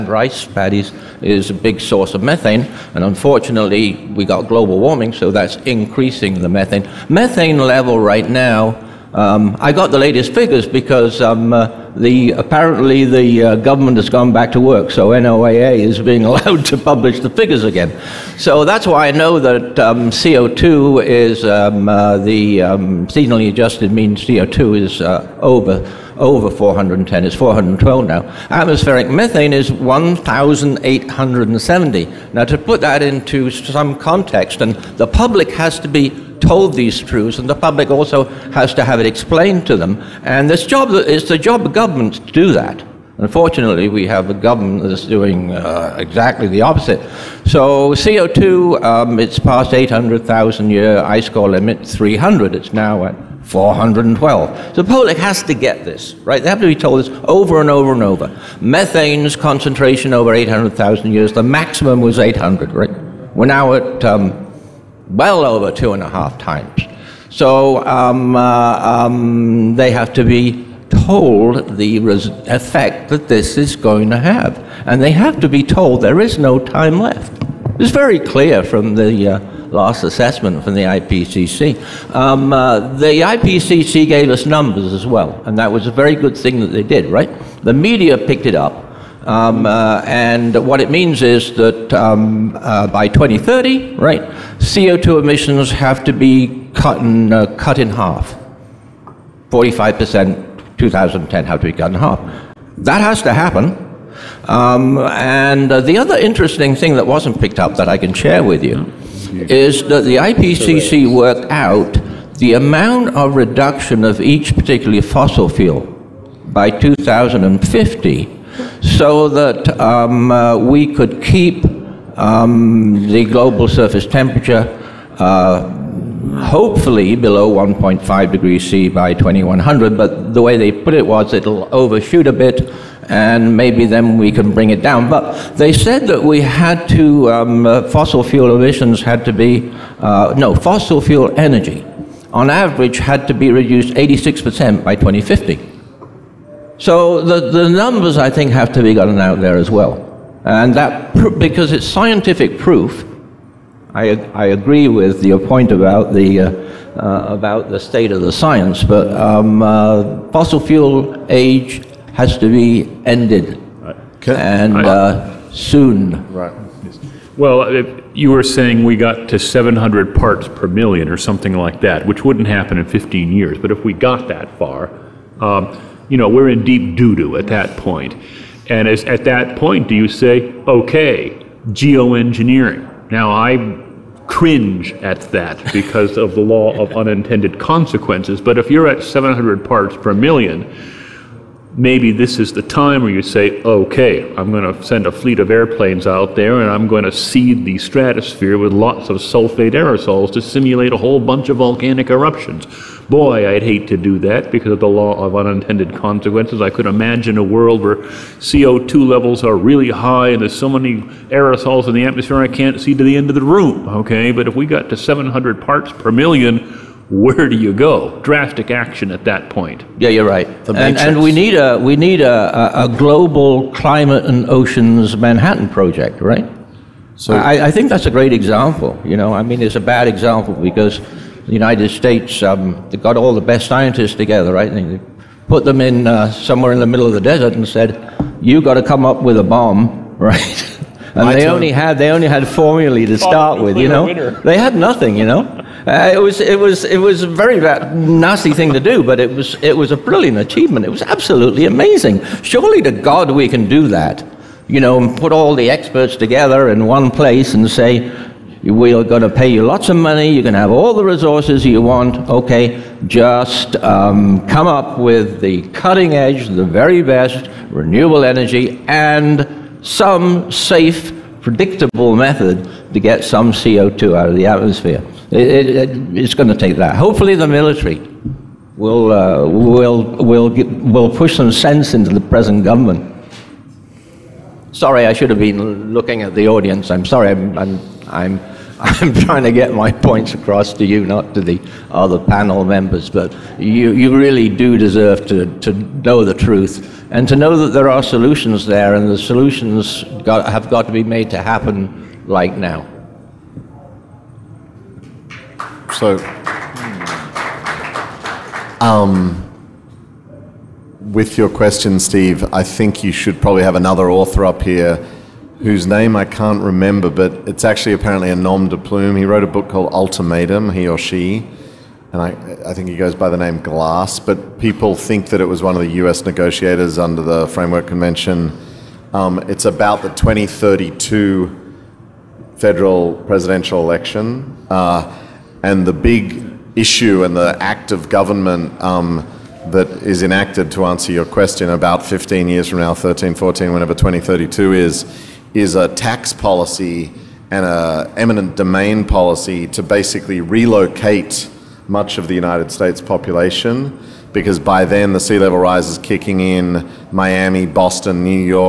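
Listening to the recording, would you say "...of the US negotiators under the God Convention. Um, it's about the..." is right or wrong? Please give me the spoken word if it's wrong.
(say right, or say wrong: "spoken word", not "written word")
wrong: "Framework", not "God".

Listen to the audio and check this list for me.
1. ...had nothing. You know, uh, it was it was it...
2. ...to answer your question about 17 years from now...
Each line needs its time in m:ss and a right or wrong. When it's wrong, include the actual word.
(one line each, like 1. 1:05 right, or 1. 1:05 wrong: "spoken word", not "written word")
1. 4:04 right
2. 5:40 wrong: "15", not "17".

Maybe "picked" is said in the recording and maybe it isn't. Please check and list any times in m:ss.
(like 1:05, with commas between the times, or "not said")
1:28, 1:47.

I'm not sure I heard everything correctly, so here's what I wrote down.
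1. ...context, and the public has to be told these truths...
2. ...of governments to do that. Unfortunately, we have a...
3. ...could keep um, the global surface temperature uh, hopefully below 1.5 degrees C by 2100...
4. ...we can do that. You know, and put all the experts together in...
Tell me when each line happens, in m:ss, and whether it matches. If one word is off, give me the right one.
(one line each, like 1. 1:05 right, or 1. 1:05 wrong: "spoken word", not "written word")
1. 0:33 right
2. 0:41 right
3. 2:00 right
4. 4:13 right.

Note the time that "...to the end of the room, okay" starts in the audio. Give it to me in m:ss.
3:32.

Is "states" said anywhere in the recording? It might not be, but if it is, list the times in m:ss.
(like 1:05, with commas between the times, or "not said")
2:37, 3:51, 5:52.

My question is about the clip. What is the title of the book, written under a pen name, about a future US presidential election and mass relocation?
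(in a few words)
Ultimatum.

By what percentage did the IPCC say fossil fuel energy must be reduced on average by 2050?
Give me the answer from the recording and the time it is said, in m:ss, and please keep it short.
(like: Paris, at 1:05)
86%, at 2:23.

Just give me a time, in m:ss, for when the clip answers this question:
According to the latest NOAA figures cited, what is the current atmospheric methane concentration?
0:29.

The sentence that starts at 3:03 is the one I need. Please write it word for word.
Now, I cringe at that because of the law of unintended consequences.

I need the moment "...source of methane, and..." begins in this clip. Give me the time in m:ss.
0:01.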